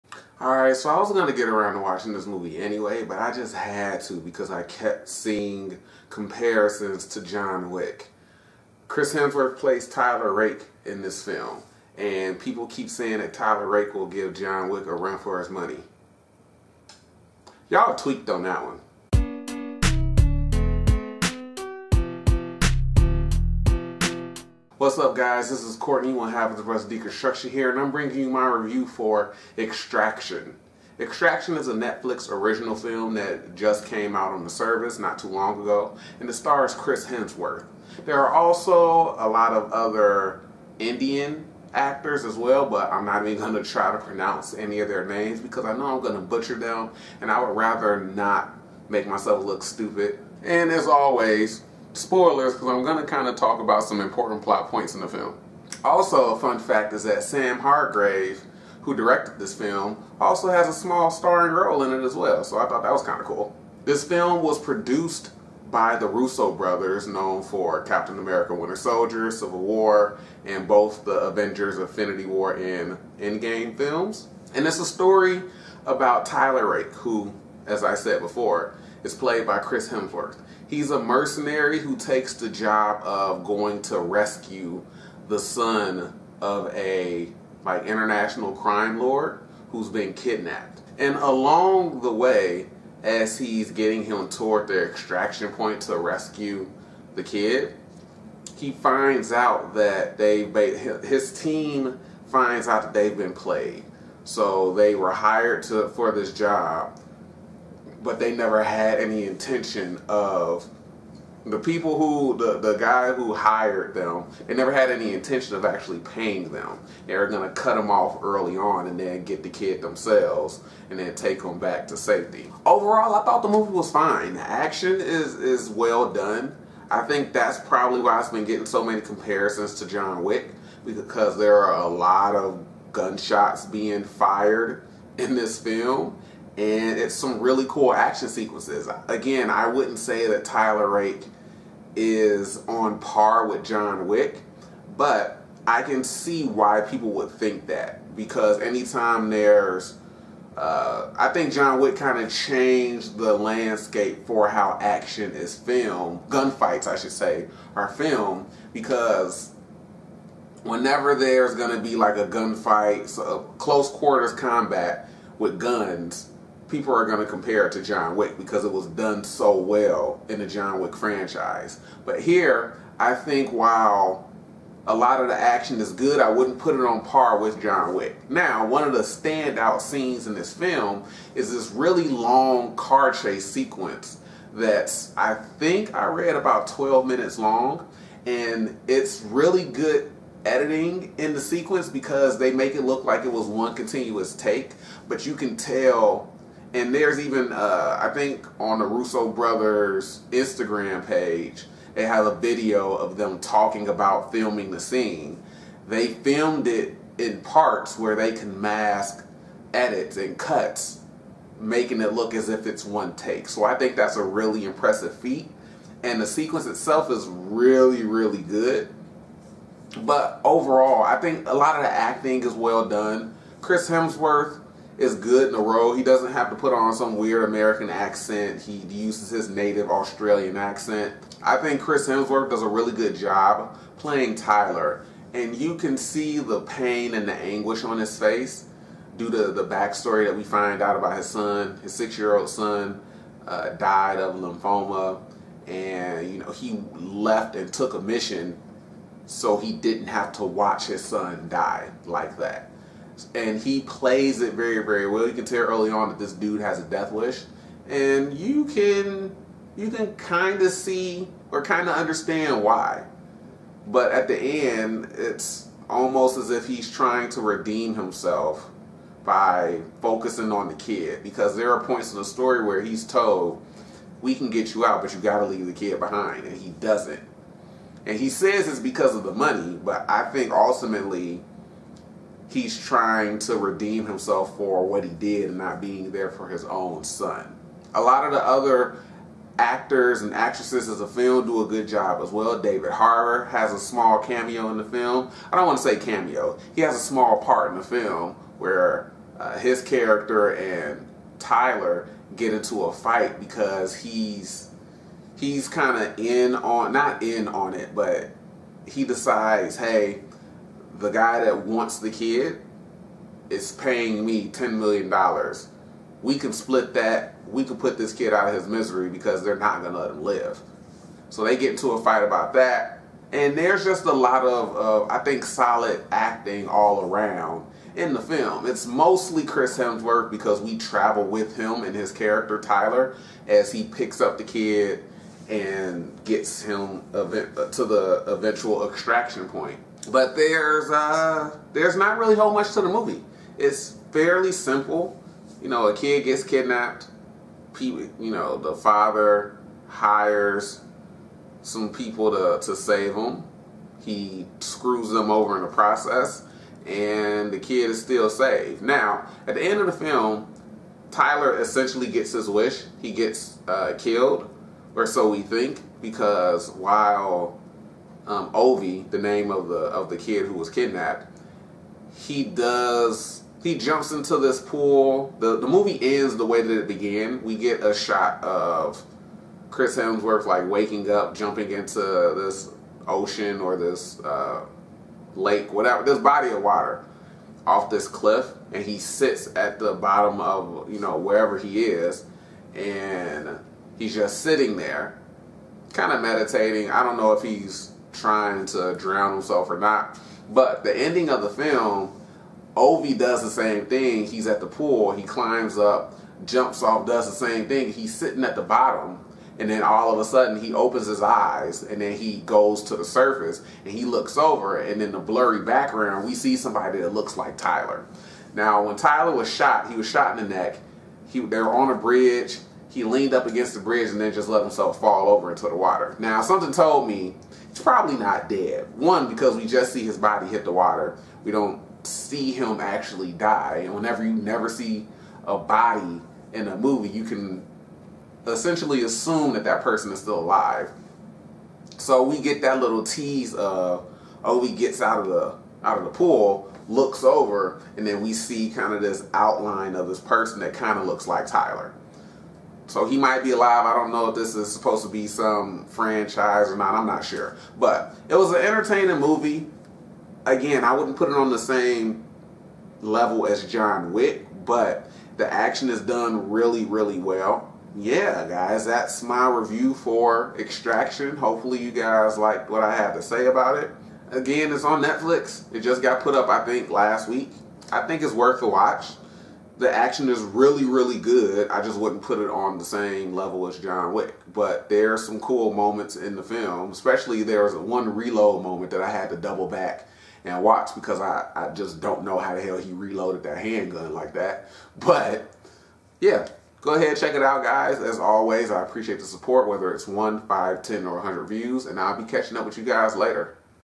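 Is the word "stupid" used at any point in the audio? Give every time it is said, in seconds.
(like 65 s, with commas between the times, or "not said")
49 s.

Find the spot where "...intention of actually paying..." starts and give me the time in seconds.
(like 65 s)
115 s.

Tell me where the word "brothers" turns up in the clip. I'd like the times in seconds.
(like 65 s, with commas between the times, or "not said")
66 s, 199 s.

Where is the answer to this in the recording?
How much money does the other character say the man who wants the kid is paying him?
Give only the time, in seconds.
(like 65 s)
314 s.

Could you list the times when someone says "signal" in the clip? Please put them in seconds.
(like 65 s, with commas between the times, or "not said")
not said.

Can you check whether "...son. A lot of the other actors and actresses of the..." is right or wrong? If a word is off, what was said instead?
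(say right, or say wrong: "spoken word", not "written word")
right.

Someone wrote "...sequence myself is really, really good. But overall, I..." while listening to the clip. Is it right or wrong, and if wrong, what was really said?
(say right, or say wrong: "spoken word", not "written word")
wrong: "itself", not "myself".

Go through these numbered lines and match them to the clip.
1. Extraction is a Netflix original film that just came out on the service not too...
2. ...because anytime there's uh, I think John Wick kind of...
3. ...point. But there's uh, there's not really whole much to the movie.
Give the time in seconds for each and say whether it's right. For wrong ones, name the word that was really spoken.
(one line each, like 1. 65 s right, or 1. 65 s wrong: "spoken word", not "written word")
1. 30 s right
2. 148 s right
3. 339 s right.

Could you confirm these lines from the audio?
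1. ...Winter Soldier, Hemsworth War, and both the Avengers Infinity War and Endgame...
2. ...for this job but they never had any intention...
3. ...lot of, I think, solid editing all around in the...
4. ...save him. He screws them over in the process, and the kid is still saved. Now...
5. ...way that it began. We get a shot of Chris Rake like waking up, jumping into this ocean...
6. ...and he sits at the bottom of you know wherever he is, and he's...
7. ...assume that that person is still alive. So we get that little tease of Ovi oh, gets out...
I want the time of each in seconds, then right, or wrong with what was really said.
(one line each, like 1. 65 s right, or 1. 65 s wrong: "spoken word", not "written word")
1. 68 s wrong: "Civil", not "Hemsworth"
2. 105 s right
3. 324 s wrong: "acting", not "editing"
4. 352 s right
5. 376 s wrong: "Hemsworth", not "Rake"
6. 388 s right
7. 439 s right.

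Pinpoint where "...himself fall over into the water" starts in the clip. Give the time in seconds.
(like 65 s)
424 s.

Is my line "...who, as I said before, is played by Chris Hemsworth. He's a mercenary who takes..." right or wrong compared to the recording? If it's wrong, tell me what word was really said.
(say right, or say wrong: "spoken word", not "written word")
right.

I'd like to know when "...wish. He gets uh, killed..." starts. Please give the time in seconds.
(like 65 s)
362 s.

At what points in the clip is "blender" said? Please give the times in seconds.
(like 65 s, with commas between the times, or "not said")
not said.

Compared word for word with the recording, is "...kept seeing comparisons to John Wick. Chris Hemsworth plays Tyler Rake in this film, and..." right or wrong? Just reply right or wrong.
right.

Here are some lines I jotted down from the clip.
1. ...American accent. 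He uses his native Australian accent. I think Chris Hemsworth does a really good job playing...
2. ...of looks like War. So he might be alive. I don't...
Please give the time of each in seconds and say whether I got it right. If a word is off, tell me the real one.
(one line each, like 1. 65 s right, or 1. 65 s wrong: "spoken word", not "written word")
1. 227 s right
2. 450 s wrong: "Tyler", not "War".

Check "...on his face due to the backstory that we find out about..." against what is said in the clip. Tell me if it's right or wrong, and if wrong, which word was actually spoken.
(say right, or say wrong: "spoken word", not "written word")
right.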